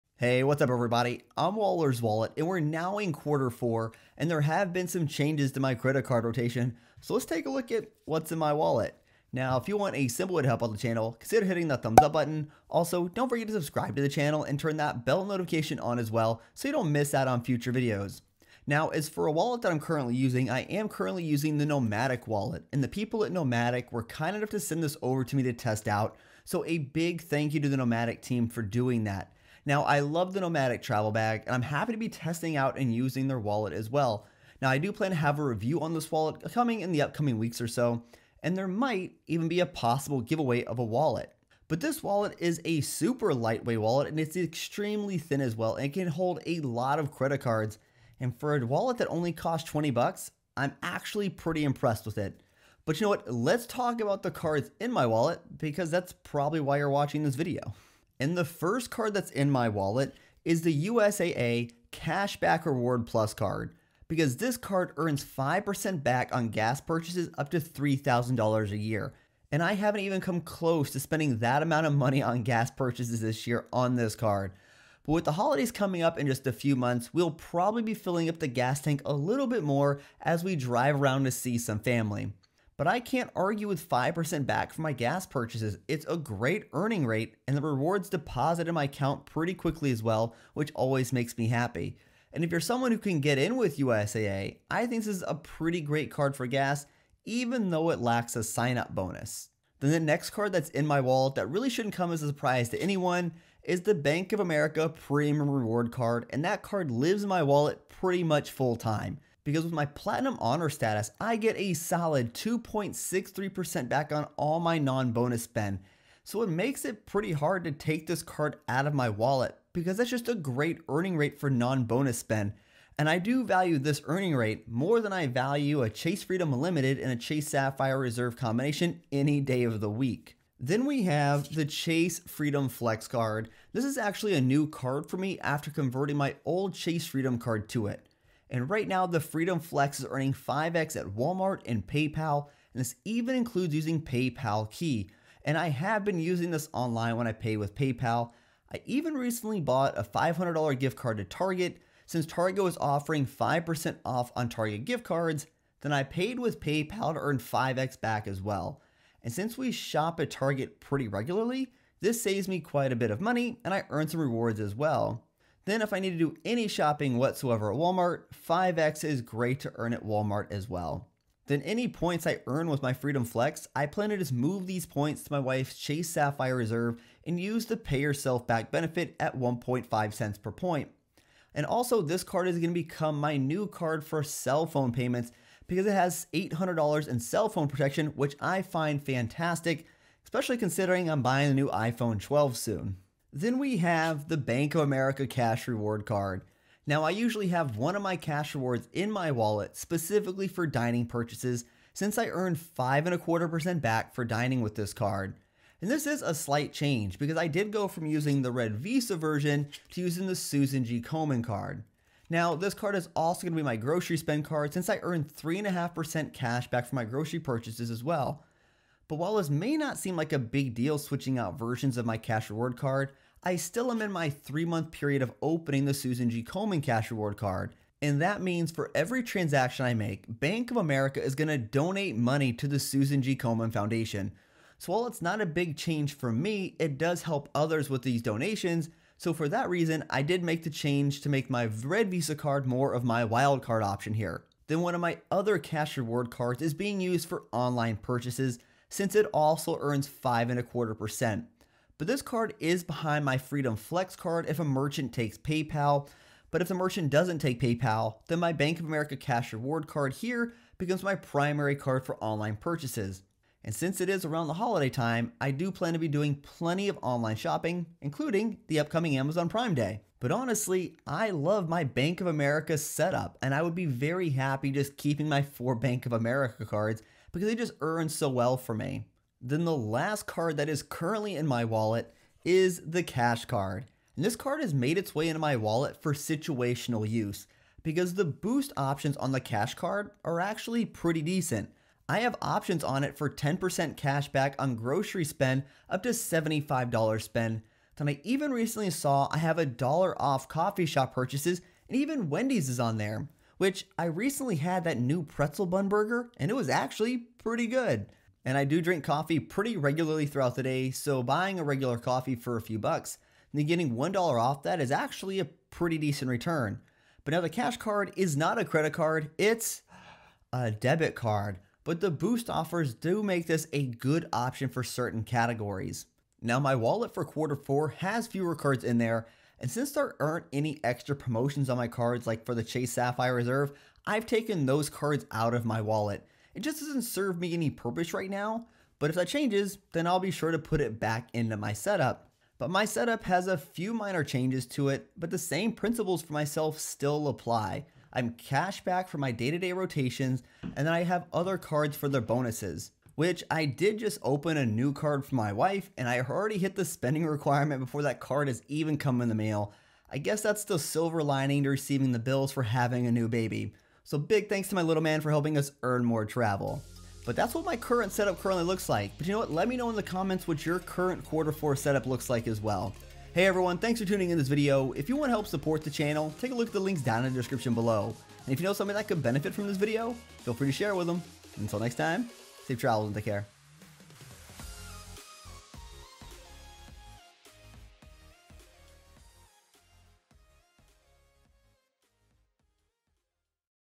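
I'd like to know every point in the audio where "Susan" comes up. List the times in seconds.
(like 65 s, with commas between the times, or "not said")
210 s, 225 s, 232 s.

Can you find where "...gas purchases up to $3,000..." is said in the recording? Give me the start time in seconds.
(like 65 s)
66 s.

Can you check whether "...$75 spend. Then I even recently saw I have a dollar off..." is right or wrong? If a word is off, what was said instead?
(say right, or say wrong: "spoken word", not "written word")
right.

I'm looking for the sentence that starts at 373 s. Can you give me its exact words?
Hey everyone, thanks for tuning in this video.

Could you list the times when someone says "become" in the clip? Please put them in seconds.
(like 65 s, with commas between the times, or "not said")
182 s, 260 s.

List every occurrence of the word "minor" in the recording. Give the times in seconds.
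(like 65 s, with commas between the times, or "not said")
343 s.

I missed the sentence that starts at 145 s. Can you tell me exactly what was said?
And I have been using this online when I pay with PayPal.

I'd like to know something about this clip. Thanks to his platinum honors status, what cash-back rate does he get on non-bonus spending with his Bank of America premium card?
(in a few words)
2.63%.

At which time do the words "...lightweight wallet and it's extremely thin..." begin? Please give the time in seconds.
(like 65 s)
43 s.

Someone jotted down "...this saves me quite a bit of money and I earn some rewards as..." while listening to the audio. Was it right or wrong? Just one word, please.
right.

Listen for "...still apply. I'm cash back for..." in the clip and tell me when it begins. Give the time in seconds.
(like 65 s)
346 s.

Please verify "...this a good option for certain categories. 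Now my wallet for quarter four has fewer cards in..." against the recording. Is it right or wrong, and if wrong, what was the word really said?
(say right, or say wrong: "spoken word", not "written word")
right.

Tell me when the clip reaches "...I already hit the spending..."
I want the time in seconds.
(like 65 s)
356 s.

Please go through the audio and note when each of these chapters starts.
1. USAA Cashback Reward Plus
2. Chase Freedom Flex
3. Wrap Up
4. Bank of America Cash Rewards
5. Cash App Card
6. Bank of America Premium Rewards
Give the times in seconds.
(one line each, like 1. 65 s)
1. 57 s
2. 130 s
3. 325 s
4. 192 s
5. 278 s
6. 99 s.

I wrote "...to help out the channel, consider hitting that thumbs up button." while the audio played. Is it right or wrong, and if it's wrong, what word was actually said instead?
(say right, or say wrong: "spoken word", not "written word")
right.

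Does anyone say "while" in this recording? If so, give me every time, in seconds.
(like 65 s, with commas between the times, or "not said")
219 s, 234 s.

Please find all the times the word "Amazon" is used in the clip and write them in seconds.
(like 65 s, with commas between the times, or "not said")
269 s.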